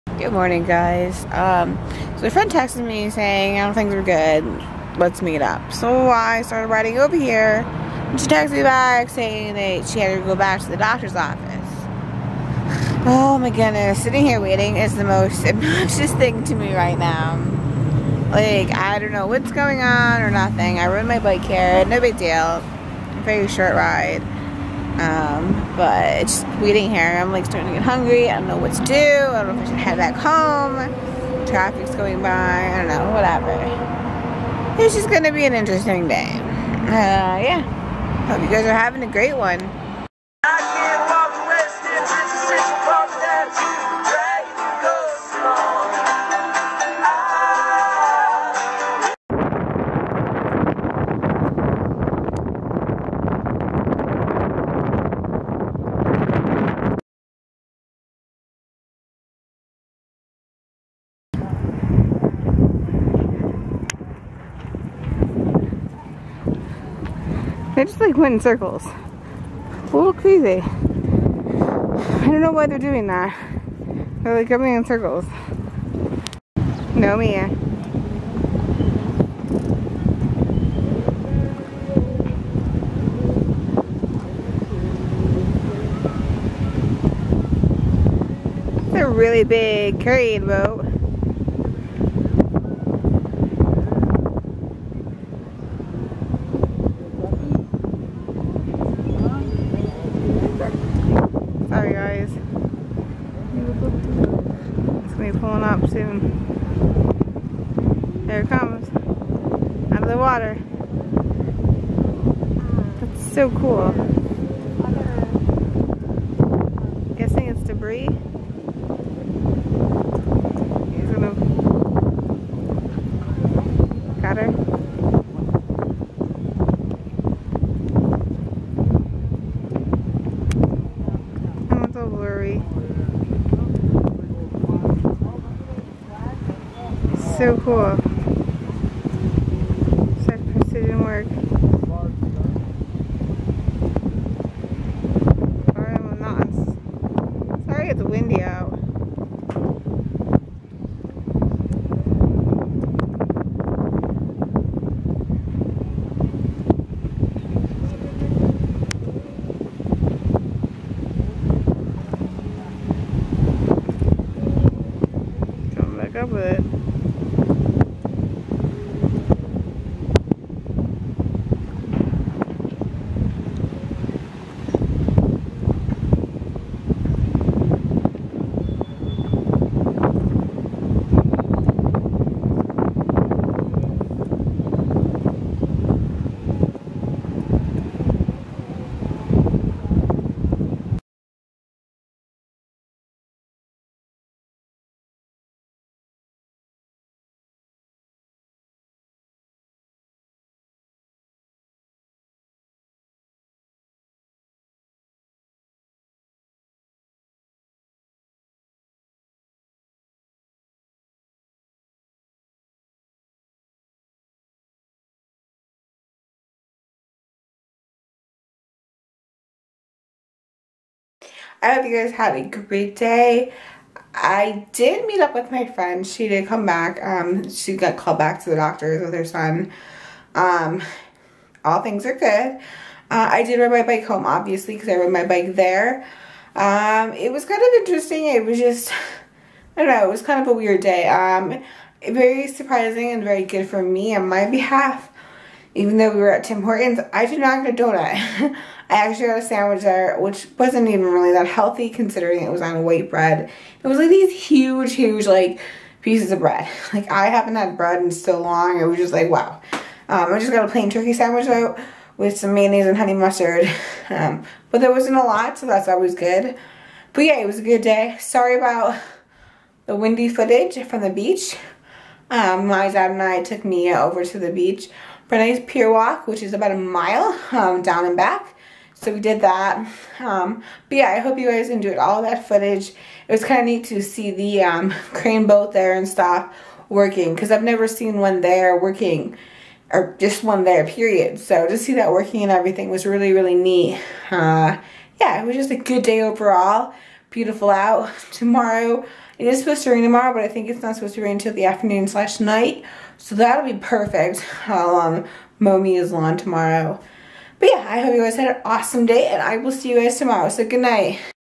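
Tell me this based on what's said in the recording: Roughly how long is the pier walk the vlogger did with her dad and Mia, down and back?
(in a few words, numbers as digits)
A mile.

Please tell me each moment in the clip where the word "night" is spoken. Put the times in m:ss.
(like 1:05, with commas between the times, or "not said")
5:02, 5:10.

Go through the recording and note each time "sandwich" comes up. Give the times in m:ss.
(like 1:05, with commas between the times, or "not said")
4:09, 4:21.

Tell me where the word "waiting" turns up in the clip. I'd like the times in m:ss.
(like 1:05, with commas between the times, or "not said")
0:14, 0:26.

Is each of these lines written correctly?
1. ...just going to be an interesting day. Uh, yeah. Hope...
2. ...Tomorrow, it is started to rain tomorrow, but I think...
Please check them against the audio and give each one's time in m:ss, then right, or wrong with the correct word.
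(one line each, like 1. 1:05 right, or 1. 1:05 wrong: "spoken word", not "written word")
1. 0:34 right
2. 4:58 wrong: "supposed", not "started".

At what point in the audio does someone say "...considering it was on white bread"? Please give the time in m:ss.
4:11.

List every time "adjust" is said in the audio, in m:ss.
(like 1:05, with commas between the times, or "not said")
not said.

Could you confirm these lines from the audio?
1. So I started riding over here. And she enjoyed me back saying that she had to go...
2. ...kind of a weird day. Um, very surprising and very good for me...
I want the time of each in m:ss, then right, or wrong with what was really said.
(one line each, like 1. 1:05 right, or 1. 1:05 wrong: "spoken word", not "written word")
1. 0:05 wrong: "texted", not "enjoyed"
2. 4:00 right.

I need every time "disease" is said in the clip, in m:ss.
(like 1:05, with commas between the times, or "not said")
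not said.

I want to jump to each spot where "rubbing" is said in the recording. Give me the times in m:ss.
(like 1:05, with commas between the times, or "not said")
not said.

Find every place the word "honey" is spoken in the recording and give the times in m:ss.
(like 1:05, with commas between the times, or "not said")
4:22.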